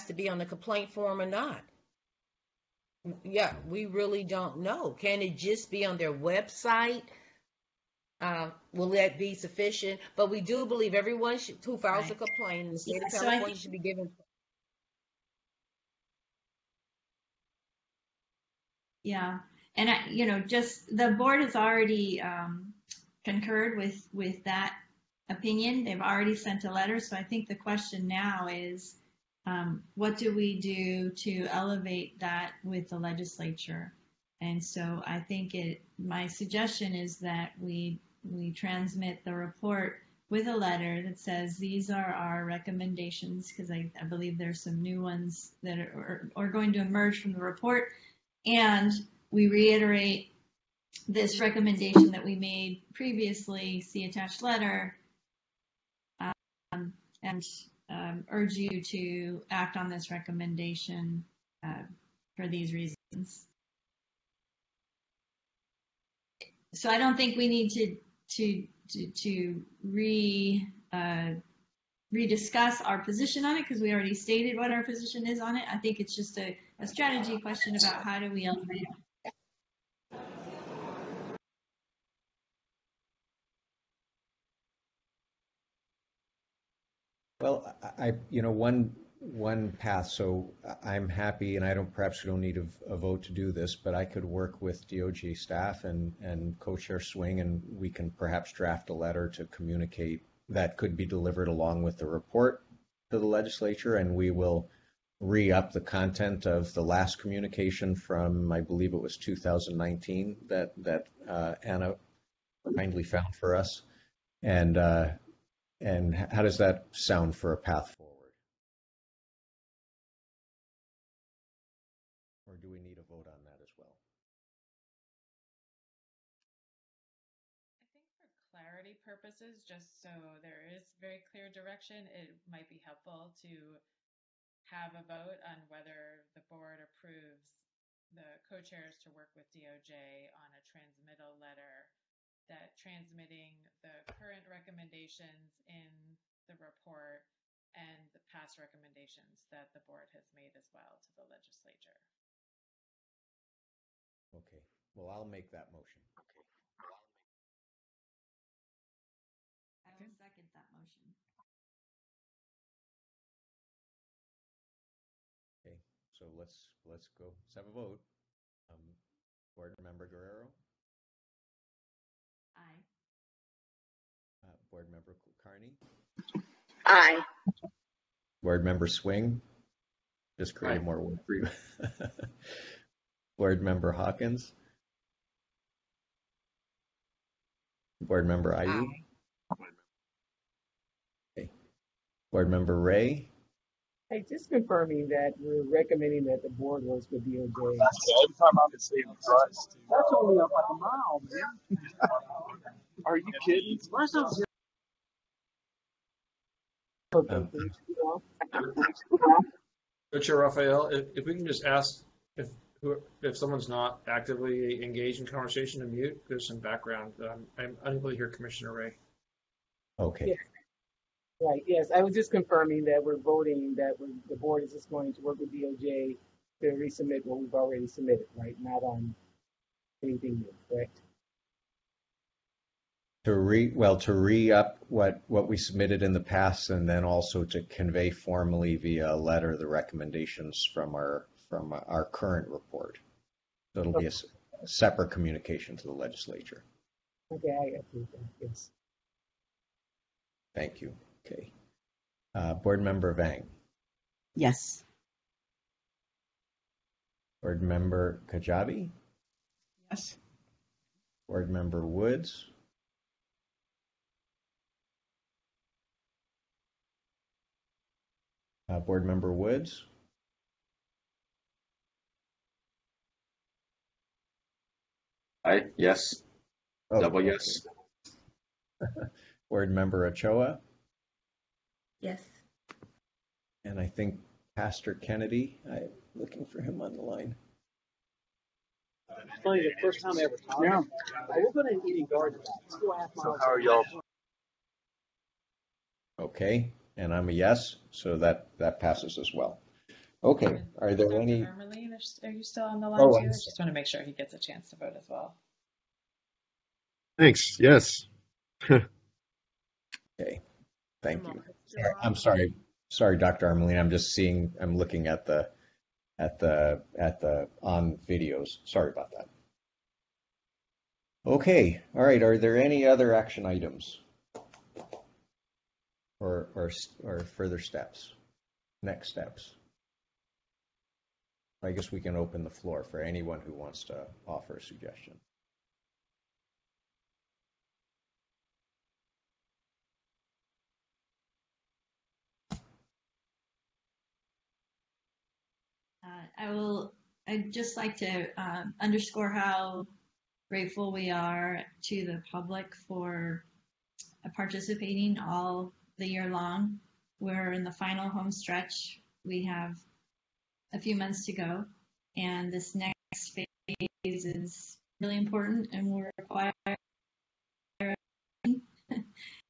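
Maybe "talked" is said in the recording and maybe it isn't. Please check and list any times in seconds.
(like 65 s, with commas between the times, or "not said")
290 s.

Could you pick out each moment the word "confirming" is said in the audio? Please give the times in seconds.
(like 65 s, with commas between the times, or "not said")
194 s, 222 s.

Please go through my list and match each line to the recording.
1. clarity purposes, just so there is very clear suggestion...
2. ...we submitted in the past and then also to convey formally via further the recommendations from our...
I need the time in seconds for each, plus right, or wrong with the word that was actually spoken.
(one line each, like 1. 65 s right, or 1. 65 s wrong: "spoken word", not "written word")
1. 128 s wrong: "direction", not "suggestion"
2. 235 s wrong: "letter", not "further".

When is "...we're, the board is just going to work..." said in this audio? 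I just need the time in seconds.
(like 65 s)
223 s.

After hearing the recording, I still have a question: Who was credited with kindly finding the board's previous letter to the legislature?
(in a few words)
Anna.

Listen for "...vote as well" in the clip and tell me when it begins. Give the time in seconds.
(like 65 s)
304 s.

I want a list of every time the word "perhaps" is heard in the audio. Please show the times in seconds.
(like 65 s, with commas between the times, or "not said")
91 s, 98 s.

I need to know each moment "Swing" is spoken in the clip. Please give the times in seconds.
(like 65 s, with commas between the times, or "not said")
96 s, 178 s.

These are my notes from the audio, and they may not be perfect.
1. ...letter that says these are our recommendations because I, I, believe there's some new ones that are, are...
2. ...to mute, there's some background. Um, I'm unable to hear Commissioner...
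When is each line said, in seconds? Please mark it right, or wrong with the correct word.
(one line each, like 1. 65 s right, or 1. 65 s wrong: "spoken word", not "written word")
1. 40 s right
2. 215 s right.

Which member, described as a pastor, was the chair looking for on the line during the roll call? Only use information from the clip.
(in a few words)
Pastor Kennedy.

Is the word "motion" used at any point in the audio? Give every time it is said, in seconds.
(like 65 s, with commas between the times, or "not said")
155 s, 160 s.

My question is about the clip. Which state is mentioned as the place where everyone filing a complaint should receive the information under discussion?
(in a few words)
California.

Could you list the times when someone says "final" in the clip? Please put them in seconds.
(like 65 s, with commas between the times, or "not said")
357 s.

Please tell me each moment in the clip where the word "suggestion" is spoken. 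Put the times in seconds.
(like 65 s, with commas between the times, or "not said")
36 s, 334 s.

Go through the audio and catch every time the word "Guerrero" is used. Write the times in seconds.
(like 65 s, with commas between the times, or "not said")
170 s.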